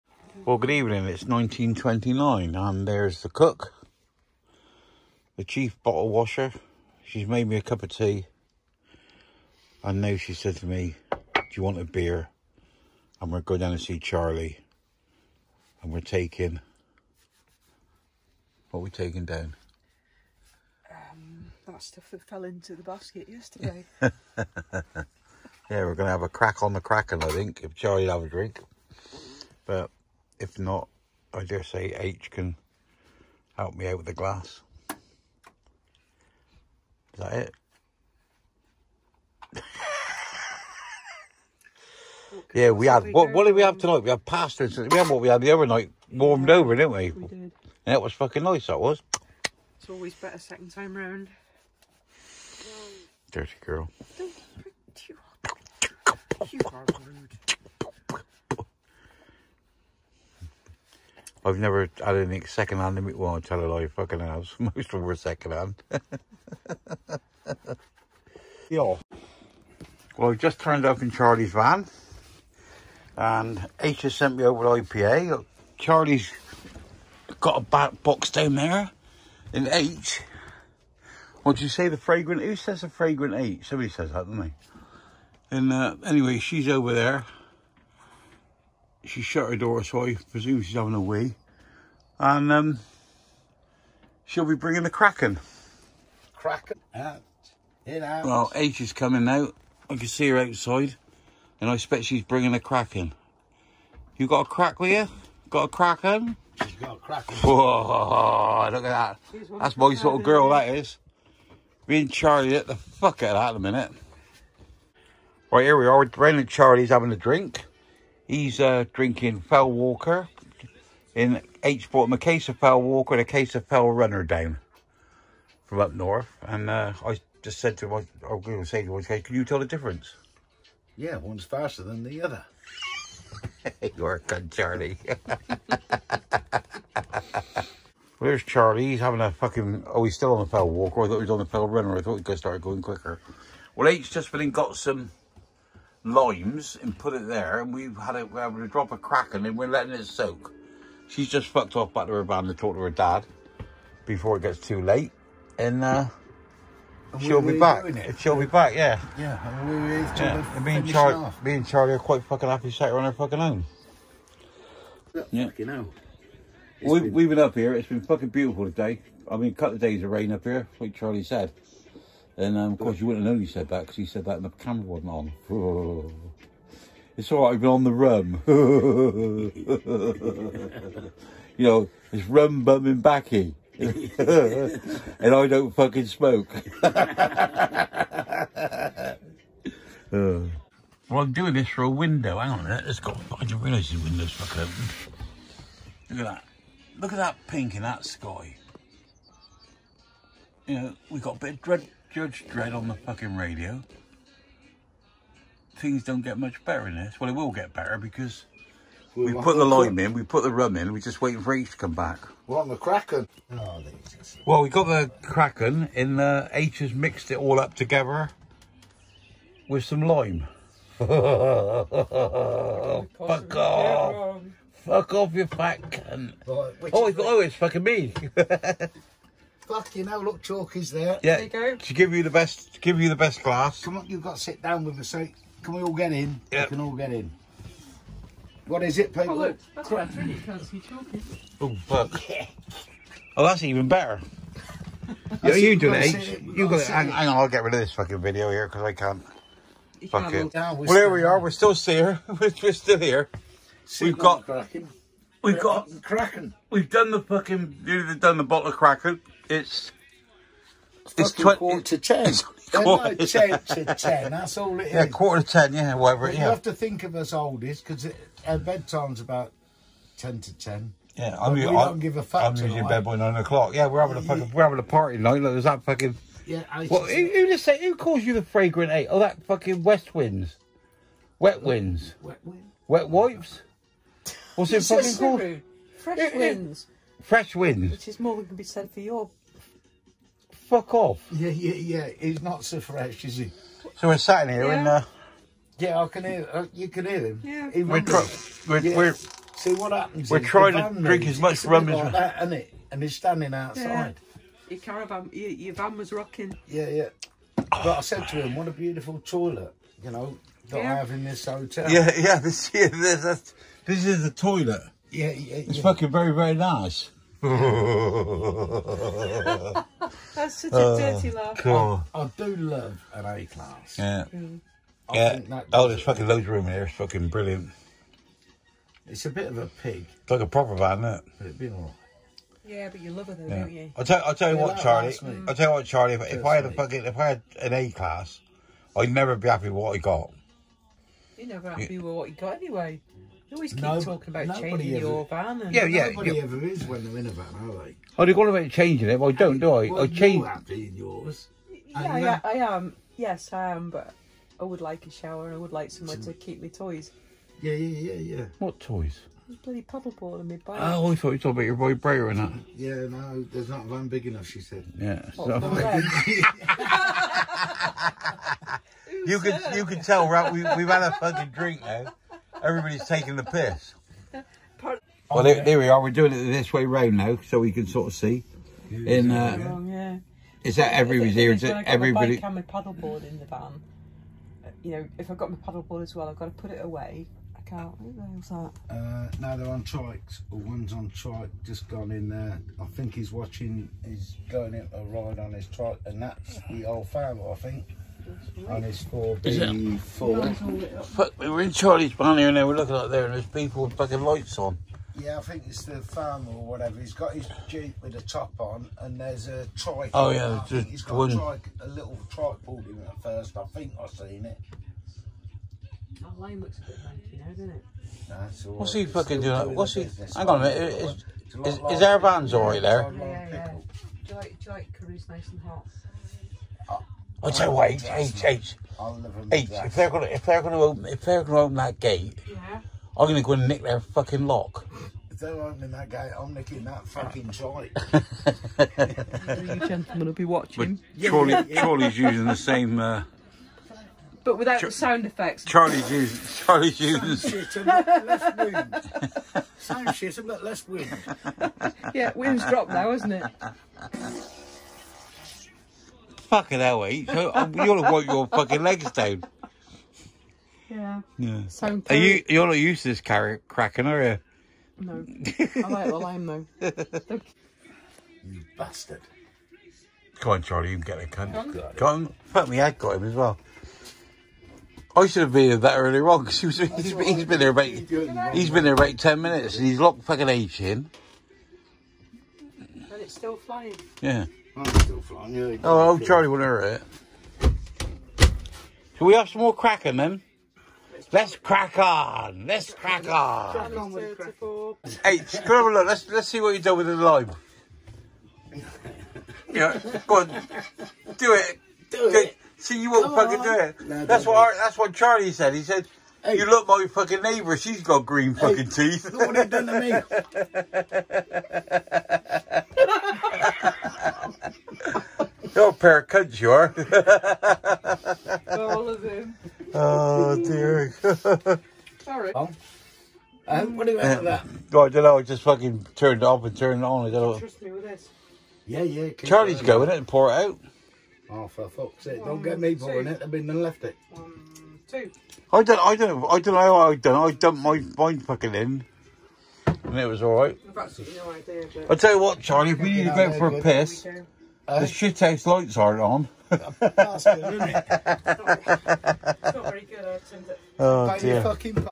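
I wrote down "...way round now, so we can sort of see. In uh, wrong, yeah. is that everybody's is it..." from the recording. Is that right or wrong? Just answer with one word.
right.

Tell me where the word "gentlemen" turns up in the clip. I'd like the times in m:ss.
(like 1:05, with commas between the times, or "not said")
7:19.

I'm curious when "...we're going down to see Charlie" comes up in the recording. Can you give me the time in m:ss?
0:13.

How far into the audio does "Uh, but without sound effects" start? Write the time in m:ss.
7:22.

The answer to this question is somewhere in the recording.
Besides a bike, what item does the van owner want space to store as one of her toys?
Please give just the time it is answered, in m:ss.
5:59.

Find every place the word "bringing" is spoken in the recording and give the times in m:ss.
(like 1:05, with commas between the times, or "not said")
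1:34, 1:42.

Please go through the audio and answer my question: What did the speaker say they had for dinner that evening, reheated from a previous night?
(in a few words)
Pasta.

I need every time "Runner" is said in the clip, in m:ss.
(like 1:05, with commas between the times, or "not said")
2:03, 2:21.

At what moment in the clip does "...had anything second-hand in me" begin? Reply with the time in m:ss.
1:02.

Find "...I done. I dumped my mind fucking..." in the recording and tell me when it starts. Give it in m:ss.
8:57.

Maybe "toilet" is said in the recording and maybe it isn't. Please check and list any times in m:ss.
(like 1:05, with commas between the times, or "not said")
5:09, 5:14.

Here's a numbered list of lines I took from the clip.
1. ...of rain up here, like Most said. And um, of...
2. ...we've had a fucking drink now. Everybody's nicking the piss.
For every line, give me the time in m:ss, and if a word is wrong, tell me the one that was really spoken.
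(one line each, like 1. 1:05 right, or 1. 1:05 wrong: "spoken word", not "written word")
1. 2:50 wrong: "Charlie", not "Most"
2. 6:10 wrong: "taking", not "nicking".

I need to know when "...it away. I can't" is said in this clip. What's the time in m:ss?
6:26.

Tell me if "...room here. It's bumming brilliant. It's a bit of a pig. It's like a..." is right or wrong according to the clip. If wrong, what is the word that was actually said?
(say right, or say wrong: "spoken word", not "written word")
wrong: "fucking", not "bumming".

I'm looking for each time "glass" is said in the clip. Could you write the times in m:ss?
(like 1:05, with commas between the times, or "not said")
0:34, 3:53.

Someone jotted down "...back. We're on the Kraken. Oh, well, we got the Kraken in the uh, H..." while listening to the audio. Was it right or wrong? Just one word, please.
right.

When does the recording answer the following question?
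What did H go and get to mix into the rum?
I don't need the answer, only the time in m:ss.
2:26.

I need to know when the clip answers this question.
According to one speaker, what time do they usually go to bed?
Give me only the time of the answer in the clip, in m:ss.
4:33.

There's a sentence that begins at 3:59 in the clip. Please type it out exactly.
Oh, look, that's what really, can't Oh, fuck.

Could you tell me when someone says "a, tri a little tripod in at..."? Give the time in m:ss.
6:51.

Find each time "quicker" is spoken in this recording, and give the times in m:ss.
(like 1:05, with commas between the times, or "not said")
2:22.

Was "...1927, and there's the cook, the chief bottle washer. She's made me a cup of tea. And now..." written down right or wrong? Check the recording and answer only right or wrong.
wrong.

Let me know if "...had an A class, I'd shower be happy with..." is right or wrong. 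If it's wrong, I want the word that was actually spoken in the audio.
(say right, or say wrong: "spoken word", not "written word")
wrong: "never", not "shower".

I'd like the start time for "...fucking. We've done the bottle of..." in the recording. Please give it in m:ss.
4:17.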